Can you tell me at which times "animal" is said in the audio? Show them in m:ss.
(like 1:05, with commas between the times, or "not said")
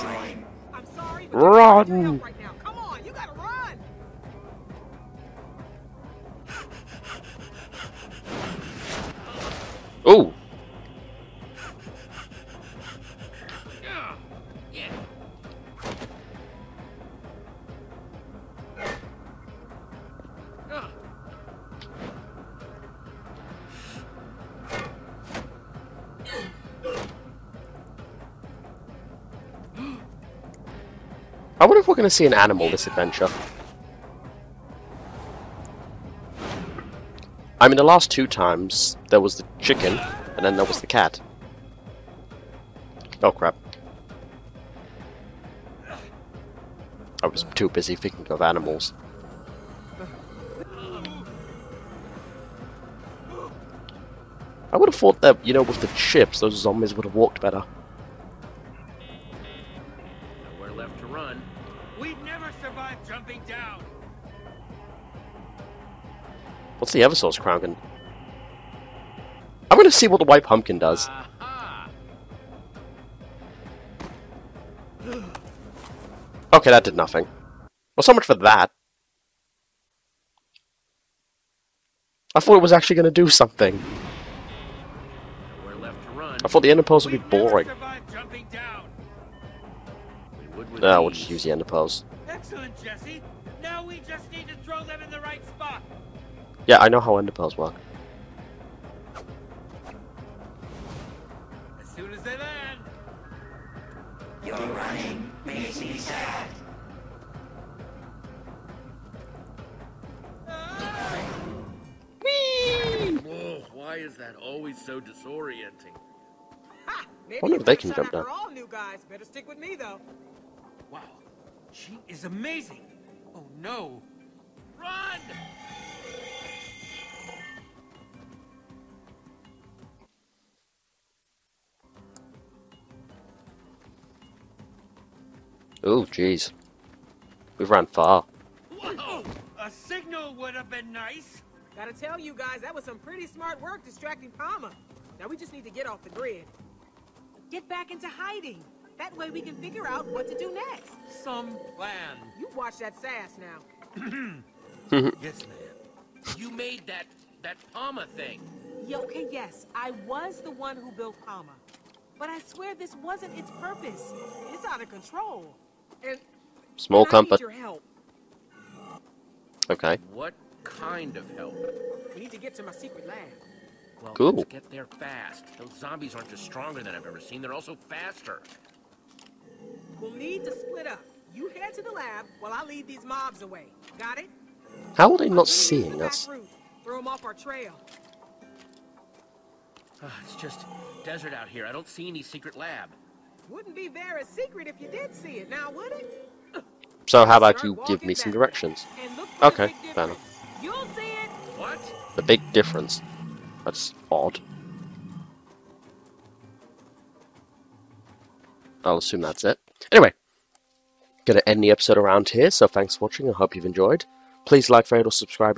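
0:32, 0:48.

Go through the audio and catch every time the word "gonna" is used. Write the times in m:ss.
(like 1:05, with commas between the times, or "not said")
1:09, 1:22.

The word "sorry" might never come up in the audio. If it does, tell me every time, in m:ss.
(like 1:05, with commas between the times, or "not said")
0:00.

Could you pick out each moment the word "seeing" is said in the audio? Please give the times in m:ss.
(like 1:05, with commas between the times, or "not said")
3:05.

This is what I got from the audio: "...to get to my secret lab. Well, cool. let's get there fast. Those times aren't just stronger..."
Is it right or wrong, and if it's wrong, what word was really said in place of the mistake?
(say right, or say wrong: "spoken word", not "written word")
wrong: "zombies", not "times".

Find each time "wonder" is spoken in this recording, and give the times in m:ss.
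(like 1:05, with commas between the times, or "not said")
0:31, 1:57.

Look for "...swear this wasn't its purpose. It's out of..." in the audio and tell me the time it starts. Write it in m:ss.
2:42.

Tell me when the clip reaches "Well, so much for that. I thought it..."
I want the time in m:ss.
1:17.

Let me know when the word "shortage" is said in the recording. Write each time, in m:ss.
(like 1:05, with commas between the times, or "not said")
not said.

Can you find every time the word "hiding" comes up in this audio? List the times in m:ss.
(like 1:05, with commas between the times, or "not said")
2:28.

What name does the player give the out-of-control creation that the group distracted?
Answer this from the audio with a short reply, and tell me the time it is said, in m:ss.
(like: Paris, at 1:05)
Pama, at 2:24.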